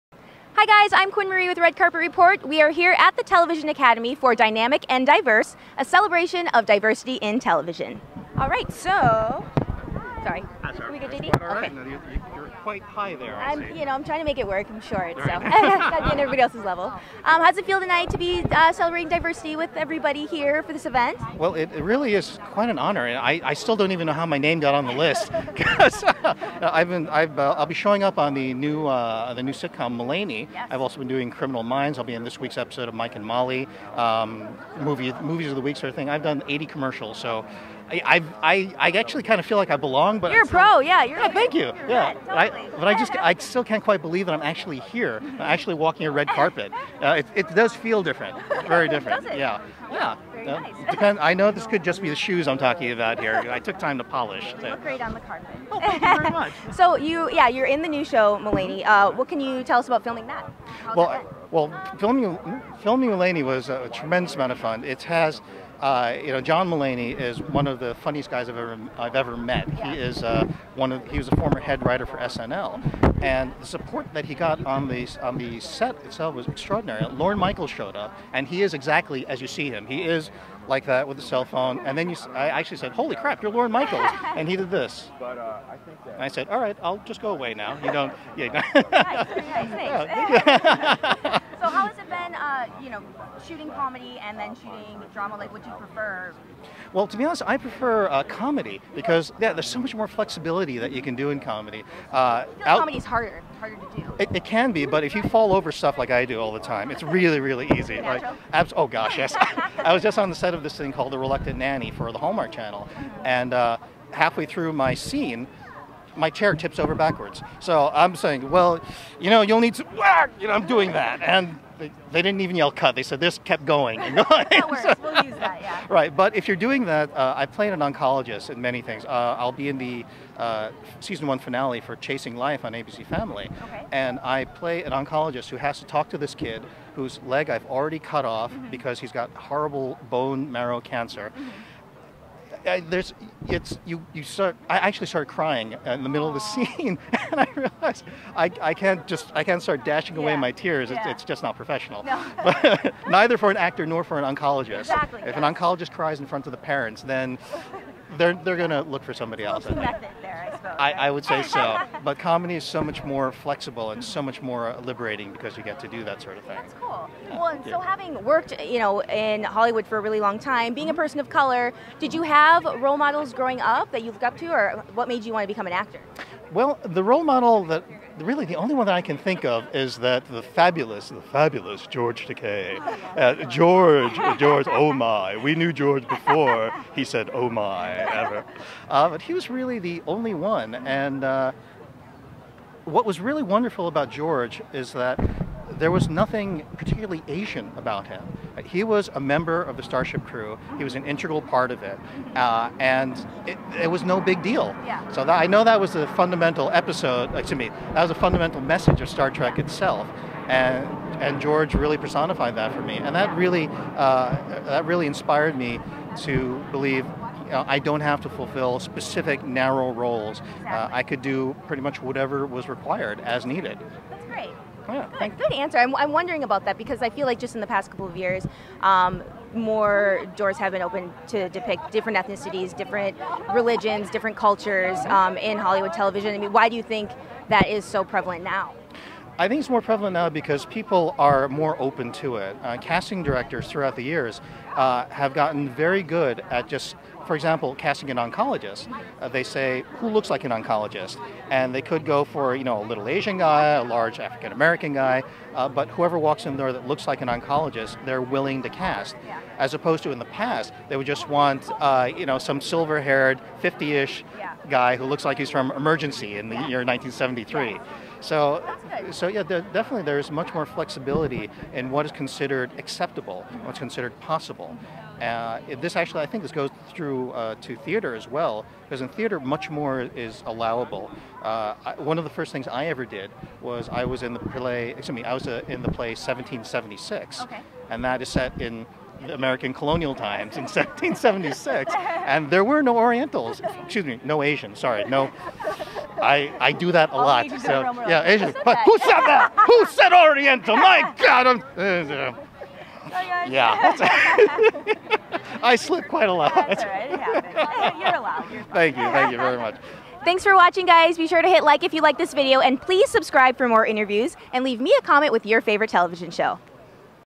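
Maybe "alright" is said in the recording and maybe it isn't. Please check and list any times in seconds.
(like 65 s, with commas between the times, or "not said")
not said.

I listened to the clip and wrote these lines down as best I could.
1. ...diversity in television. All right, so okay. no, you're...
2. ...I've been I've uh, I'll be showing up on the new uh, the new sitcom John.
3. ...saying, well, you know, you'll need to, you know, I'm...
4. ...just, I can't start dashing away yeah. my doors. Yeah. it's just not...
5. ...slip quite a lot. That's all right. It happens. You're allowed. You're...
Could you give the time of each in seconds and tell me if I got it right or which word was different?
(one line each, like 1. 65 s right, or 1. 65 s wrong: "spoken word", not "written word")
1. 6 s right
2. 26 s wrong: "Mulaney", not "John"
3. 118 s right
4. 149 s wrong: "tears", not "doors"
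5. 305 s right.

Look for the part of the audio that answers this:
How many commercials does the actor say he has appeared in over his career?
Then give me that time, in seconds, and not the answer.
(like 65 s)
36 s.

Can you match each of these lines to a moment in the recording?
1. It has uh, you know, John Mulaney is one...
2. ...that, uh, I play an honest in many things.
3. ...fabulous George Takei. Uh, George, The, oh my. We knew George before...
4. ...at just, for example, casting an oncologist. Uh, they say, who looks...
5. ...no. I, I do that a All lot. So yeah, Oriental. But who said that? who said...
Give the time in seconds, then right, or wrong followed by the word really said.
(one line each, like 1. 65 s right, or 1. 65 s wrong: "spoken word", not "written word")
1. 64 s right
2. 126 s wrong: "oncologist", not "honest"
3. 181 s wrong: "George", not "The"
4. 246 s right
5. 295 s wrong: "Asian", not "Oriental".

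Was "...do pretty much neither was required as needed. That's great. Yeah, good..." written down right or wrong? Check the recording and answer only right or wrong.
wrong.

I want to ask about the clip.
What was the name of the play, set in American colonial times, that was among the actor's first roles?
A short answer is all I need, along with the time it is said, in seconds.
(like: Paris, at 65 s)
1776, at 285 s.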